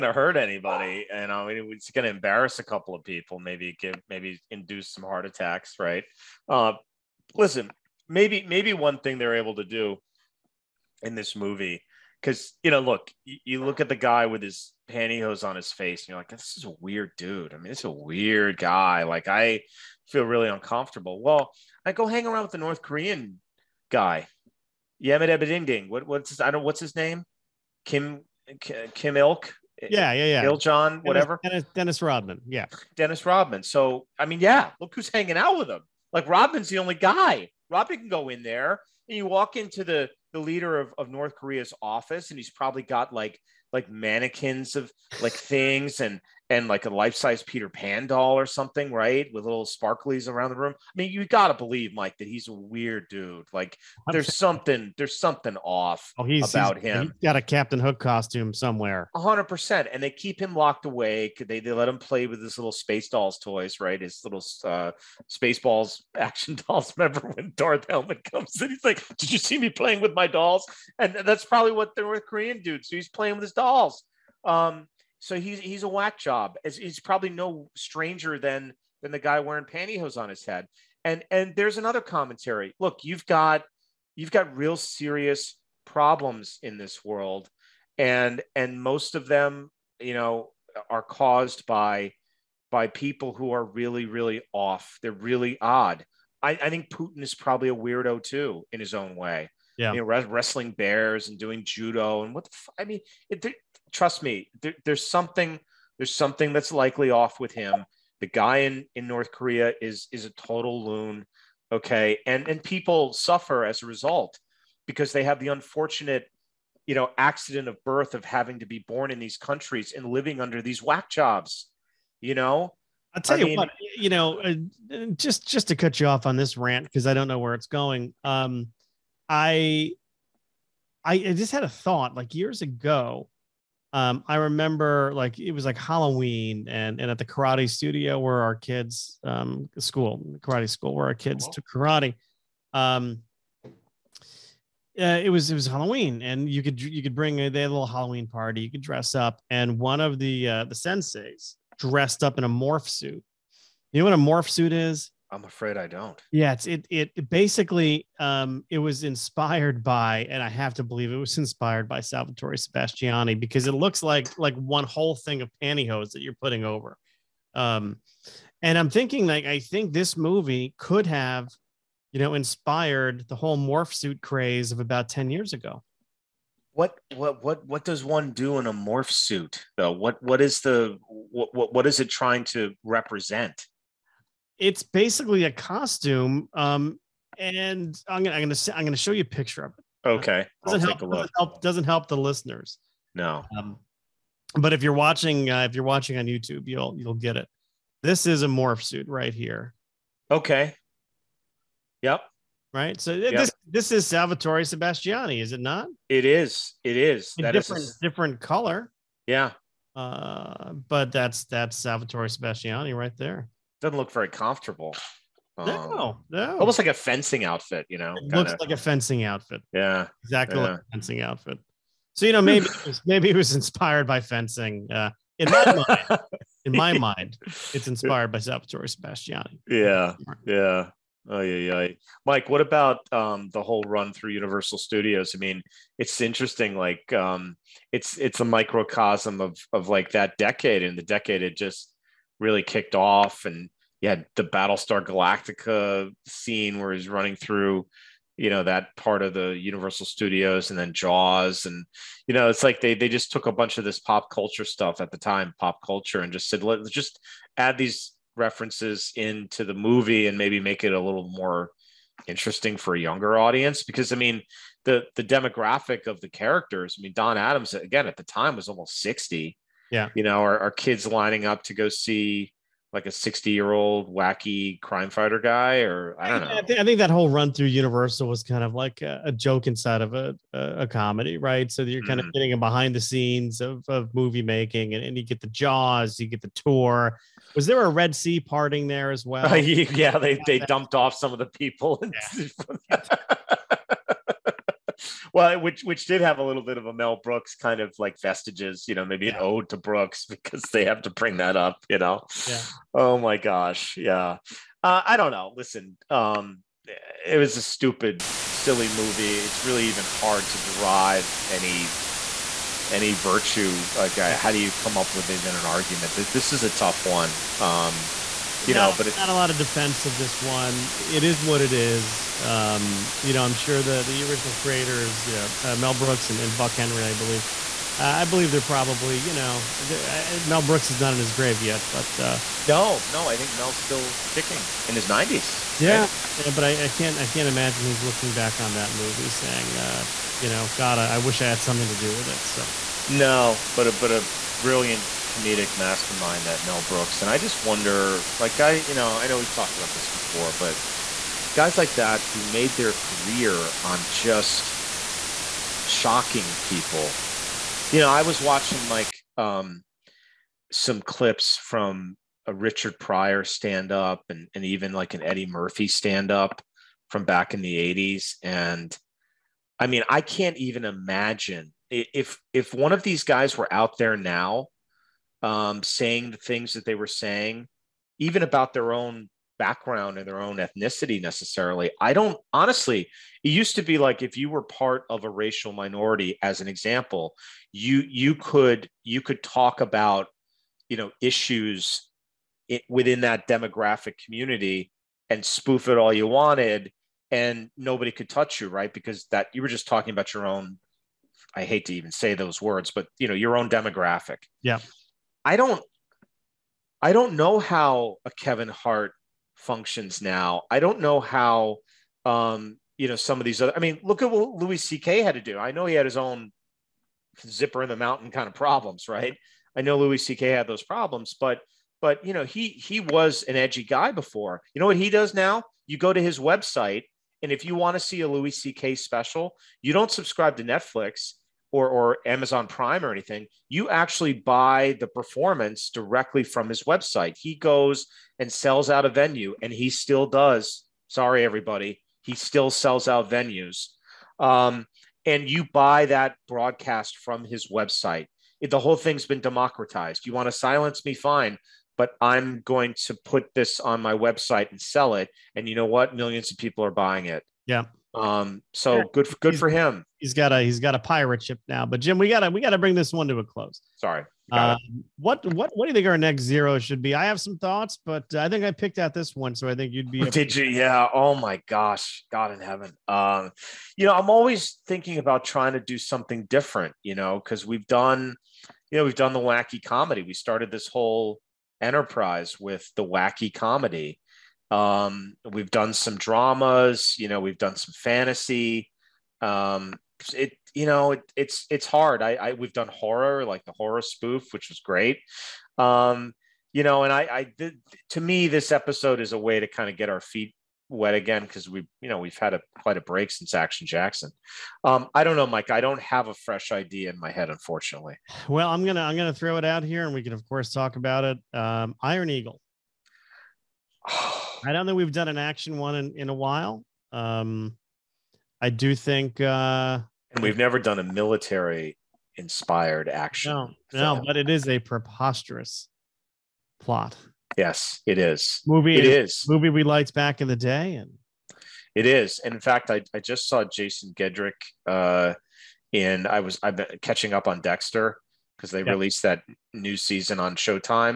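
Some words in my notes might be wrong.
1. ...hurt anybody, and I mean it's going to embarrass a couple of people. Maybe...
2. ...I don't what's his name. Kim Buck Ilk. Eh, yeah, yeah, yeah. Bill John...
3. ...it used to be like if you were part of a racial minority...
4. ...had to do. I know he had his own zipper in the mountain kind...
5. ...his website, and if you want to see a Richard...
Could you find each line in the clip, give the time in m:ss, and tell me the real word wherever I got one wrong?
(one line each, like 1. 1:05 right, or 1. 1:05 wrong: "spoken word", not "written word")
1. 0:00 right
2. 0:26 wrong: "Kim", not "Buck"
3. 6:23 right
4. 6:55 right
5. 7:06 wrong: "Louis", not "Richard".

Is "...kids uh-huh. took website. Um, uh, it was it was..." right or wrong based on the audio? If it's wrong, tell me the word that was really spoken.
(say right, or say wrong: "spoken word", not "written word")
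wrong: "karate", not "website".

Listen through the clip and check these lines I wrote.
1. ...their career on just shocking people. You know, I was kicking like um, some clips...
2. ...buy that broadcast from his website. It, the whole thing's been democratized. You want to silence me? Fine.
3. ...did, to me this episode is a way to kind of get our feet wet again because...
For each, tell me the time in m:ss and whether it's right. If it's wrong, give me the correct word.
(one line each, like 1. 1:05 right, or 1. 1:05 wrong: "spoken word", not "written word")
1. 5:52 wrong: "watching", not "kicking"
2. 7:25 right
3. 8:17 right.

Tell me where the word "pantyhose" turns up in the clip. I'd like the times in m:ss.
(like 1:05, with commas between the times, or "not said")
0:14, 1:19, 2:45.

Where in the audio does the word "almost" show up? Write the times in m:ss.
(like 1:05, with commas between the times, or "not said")
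3:36, 4:28.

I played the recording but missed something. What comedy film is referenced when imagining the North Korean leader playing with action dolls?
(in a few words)
Spaceballs.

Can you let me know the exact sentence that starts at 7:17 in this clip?
He goes and sells out a venue, and he still does.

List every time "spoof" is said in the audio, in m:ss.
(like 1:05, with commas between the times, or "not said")
6:35, 8:14.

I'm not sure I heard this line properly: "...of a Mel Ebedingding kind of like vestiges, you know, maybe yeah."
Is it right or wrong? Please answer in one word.
wrong.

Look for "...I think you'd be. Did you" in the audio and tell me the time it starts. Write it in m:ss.
7:49.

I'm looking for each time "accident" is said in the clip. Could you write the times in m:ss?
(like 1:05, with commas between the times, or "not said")
1:57.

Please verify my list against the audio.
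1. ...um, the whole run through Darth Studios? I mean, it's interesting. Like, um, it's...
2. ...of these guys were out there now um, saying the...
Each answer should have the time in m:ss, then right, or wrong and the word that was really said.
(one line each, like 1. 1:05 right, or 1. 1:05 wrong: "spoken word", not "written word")
1. 3:53 wrong: "Universal", not "Darth"
2. 6:12 right.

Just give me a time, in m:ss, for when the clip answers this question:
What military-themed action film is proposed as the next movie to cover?
8:32.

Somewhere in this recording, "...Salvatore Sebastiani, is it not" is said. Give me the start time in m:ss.
3:24.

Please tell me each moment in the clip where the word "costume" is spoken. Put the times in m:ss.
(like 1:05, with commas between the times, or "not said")
0:57, 3:05.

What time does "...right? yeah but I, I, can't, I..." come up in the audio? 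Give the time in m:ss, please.
5:36.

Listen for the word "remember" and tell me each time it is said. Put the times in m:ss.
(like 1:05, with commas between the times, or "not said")
1:06, 2:14.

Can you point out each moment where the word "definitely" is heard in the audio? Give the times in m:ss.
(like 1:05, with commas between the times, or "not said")
not said.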